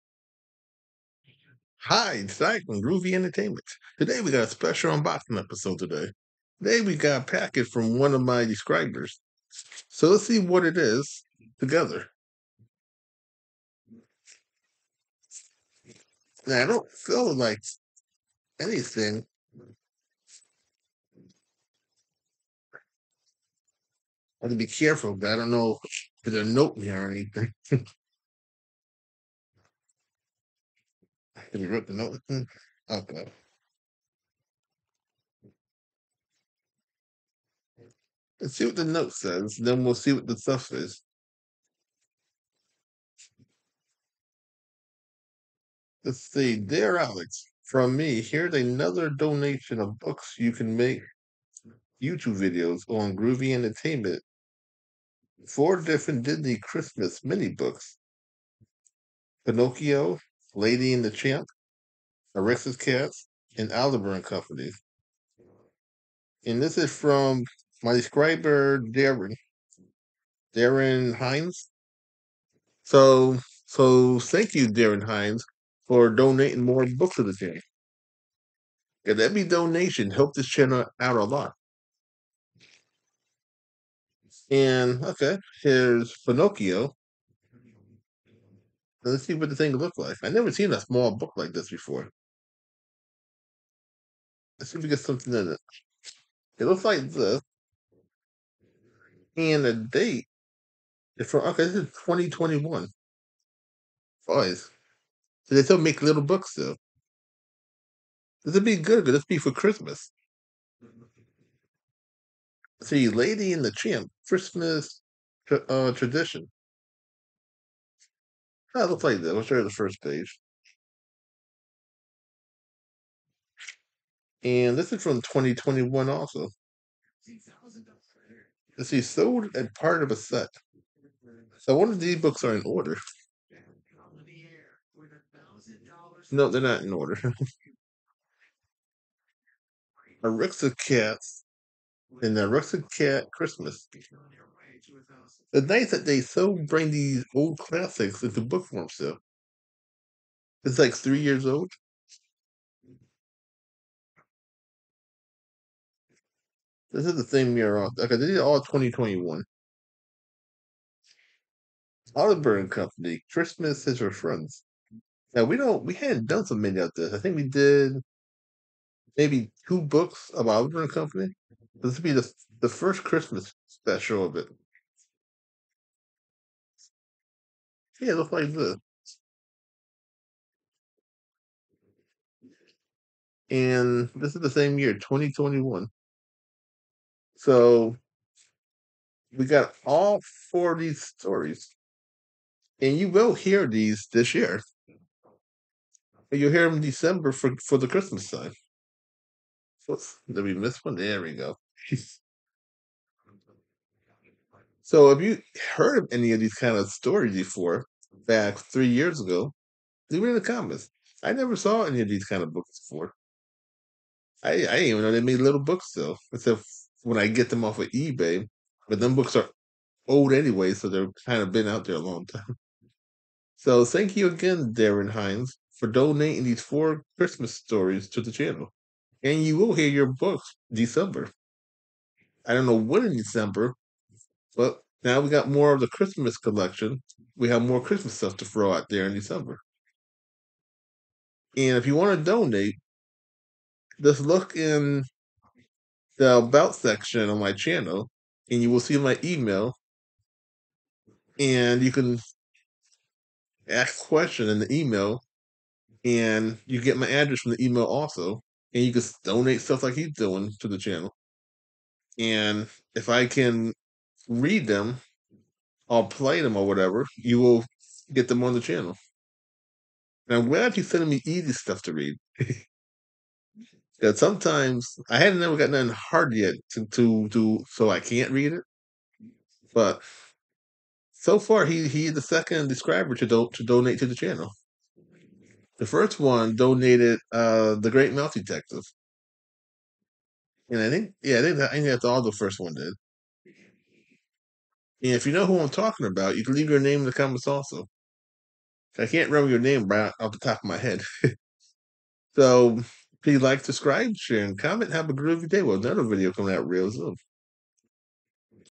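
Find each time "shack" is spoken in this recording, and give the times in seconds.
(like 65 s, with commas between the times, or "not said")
not said.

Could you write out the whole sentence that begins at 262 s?
And if I can read them, or play them or whatever, you will get them on the channel.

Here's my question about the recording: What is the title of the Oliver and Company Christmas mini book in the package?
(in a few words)
Christmas Is Our Friends.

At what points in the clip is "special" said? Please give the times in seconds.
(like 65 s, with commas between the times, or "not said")
4 s, 173 s.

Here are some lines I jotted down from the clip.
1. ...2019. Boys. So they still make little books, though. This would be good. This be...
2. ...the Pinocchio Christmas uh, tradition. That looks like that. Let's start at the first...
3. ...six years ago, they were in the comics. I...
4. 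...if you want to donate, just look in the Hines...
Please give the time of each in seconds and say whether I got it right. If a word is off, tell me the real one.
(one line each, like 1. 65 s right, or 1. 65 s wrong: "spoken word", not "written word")
1. 101 s wrong: "2021", not "2019"
2. 113 s wrong: "Tramp", not "Pinocchio"
3. 208 s wrong: "three", not "six"
4. 241 s wrong: "About", not "Hines".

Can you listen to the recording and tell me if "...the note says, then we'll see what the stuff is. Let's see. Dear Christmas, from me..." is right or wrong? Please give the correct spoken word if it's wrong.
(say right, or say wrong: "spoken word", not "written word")
wrong: "Alex", not "Christmas".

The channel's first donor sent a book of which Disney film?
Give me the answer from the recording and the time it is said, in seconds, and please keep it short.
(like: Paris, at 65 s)
The Great Mouse Detective, at 287 s.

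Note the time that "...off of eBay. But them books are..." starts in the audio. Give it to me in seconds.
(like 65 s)
217 s.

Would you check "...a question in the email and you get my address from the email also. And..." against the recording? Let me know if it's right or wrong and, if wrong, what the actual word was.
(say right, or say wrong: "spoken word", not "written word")
right.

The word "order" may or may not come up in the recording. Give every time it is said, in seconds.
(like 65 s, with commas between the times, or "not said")
132 s, 136 s.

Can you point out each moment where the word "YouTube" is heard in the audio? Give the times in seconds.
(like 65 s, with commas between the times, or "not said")
52 s.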